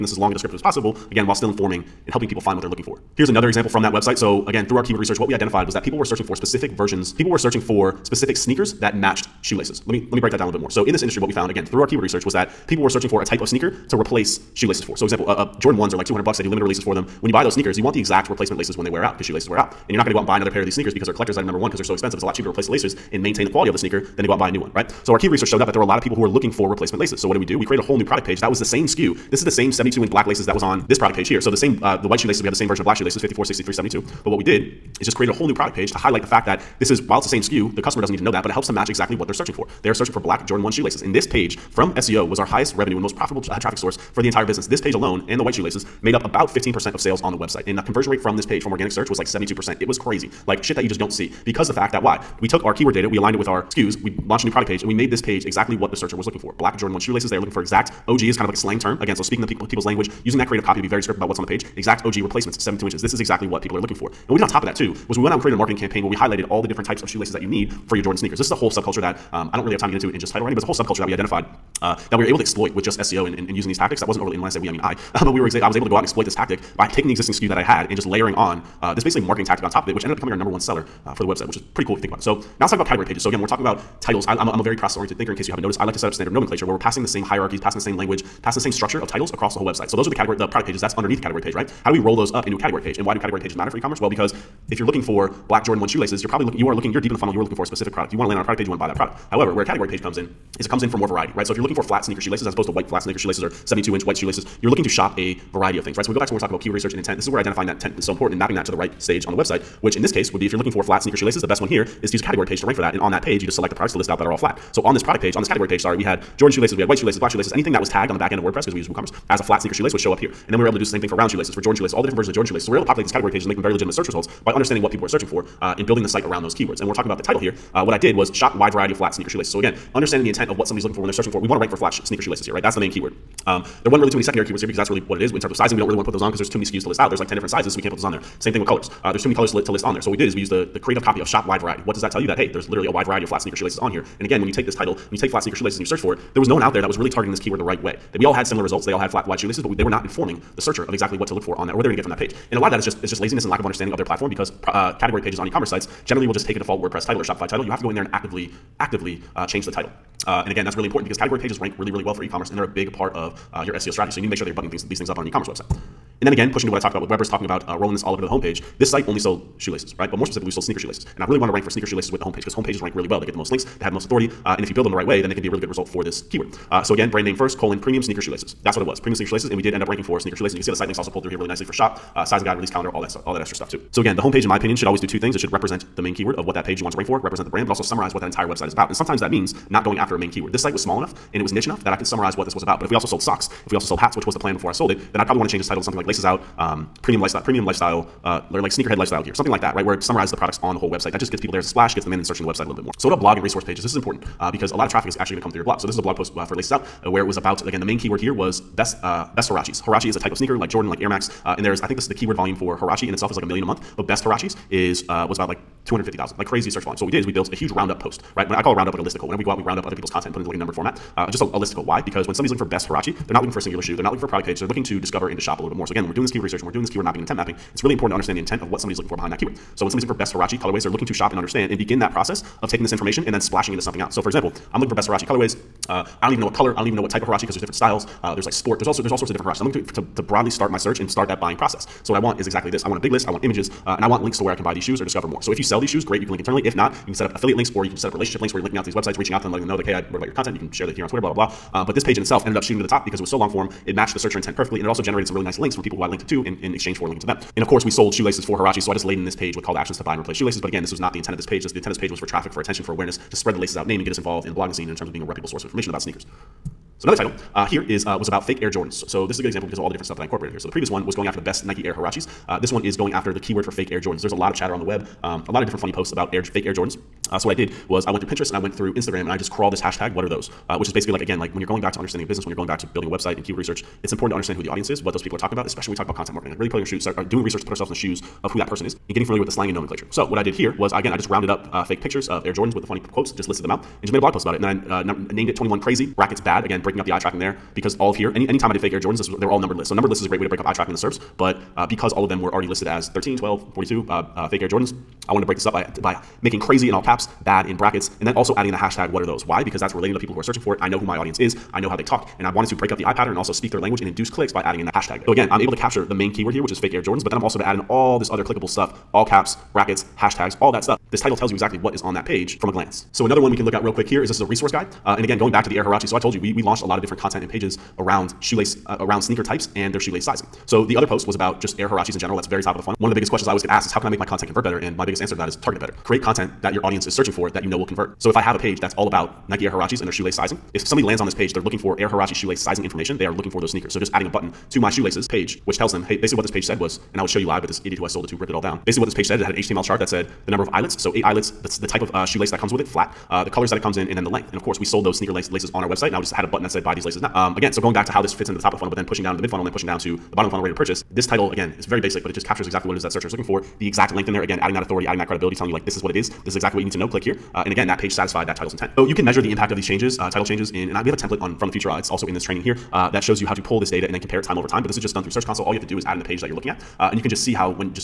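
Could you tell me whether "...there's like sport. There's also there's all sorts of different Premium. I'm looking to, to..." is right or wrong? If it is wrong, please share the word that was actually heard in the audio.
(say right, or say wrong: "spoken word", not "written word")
wrong: "Huaraches", not "Premium".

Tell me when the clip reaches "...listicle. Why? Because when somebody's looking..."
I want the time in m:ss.
3:41.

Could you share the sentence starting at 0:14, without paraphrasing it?
So example, uh, uh, Jordan 1s are like 200 bucks.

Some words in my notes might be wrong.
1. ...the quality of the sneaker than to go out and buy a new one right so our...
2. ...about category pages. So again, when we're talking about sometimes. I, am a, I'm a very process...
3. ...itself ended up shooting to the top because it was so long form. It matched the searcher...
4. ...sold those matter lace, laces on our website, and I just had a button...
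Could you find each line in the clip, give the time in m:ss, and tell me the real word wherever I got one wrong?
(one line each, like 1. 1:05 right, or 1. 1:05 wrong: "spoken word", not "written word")
1. 0:23 right
2. 1:22 wrong: "titles", not "sometimes"
3. 4:12 right
4. 5:54 wrong: "sneaker", not "matter".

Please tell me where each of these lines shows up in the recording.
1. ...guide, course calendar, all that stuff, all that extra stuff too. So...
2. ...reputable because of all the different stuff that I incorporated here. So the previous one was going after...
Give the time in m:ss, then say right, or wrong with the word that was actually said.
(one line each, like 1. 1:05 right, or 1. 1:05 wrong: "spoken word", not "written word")
1. 3:02 wrong: "release", not "course"
2. 4:29 wrong: "example", not "reputable".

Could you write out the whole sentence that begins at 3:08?
And sometimes that means not going after a main keyword.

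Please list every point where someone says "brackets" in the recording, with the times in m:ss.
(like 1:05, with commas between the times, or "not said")
4:56, 5:07, 5:19.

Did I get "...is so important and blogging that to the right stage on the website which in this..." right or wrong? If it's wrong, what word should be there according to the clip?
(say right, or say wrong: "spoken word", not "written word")
wrong: "mapping", not "blogging".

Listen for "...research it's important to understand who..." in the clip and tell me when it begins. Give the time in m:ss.
4:43.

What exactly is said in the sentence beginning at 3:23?
This is important uh, because a lot of traffic is actually going to come through your blog.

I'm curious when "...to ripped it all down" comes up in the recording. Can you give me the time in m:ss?
5:48.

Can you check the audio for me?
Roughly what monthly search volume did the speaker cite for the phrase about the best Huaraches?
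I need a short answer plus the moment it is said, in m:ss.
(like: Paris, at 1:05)
250,000, at 3:35.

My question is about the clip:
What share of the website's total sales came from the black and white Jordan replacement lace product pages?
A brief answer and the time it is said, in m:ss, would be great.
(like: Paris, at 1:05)
15%, at 0:46.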